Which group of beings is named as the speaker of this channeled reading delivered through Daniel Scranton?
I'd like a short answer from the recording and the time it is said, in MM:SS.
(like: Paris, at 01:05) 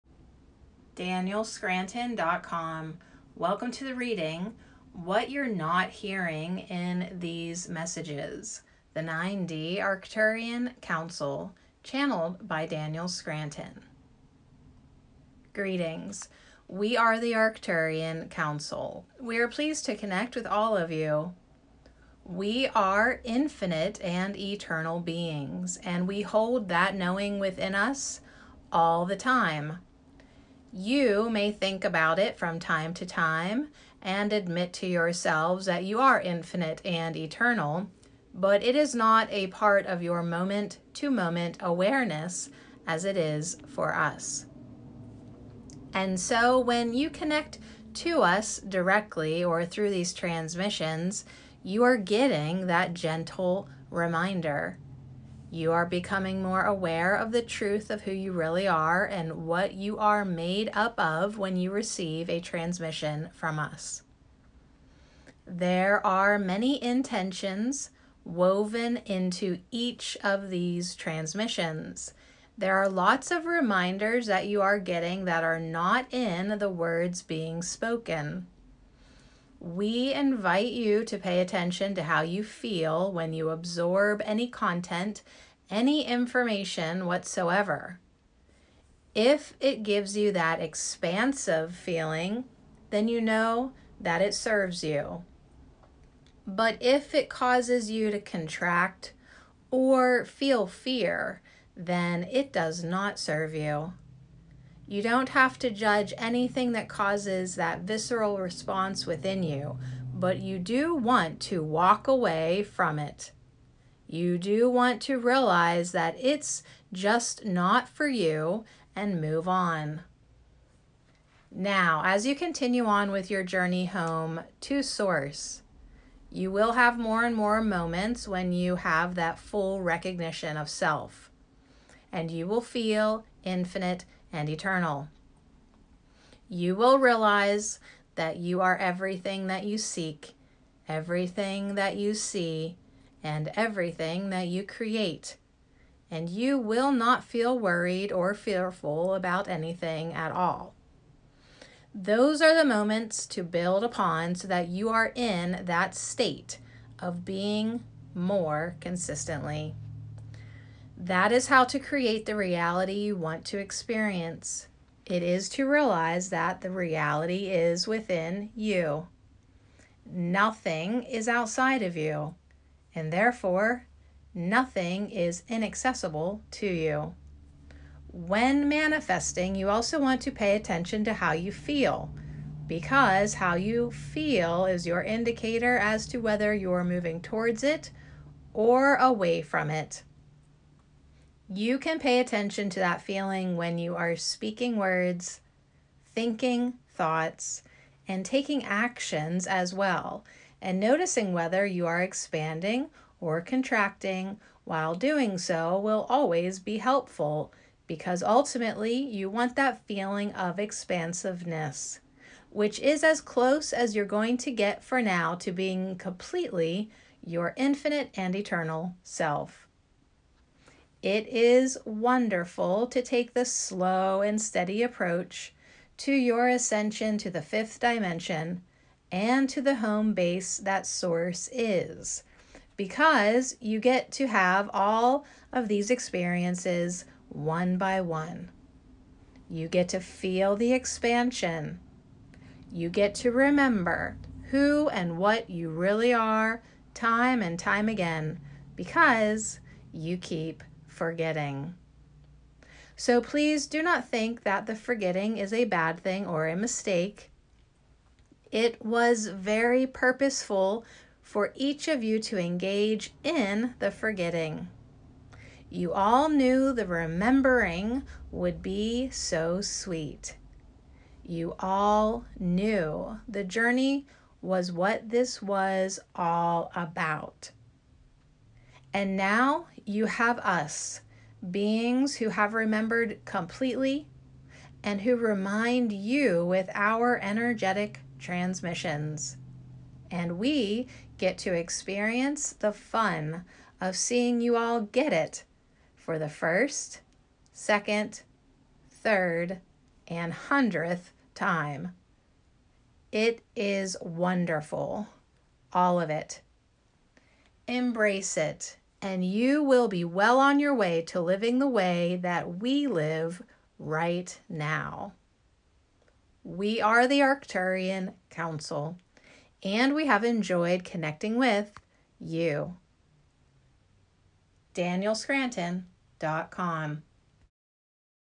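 9D Arcturian Council, at 00:08.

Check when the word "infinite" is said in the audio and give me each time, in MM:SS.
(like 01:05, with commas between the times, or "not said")
00:23, 00:36, 02:13, 03:37.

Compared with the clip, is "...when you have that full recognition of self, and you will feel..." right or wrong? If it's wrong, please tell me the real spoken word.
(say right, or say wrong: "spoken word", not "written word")
right.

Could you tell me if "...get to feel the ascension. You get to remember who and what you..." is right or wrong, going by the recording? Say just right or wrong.
wrong.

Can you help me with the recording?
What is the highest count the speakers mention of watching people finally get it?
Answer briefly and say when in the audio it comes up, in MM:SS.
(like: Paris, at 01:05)
100th, at 05:00.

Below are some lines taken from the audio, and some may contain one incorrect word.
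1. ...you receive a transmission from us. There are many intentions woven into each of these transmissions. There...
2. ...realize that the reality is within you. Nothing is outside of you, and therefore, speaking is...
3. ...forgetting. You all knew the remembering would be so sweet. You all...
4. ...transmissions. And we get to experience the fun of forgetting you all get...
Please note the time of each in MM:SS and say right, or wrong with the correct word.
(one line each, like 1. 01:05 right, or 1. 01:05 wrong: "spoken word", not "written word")
1. 01:01 right
2. 02:45 wrong: "nothing", not "speaking"
3. 04:23 right
4. 04:48 wrong: "seeing", not "forgetting".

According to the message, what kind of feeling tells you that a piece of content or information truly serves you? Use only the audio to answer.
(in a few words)
expansive feeling.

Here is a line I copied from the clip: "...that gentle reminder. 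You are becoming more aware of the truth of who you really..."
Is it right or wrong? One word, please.
right.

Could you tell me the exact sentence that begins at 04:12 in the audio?
So please do not think that the forgetting is a bad thing or a mistake.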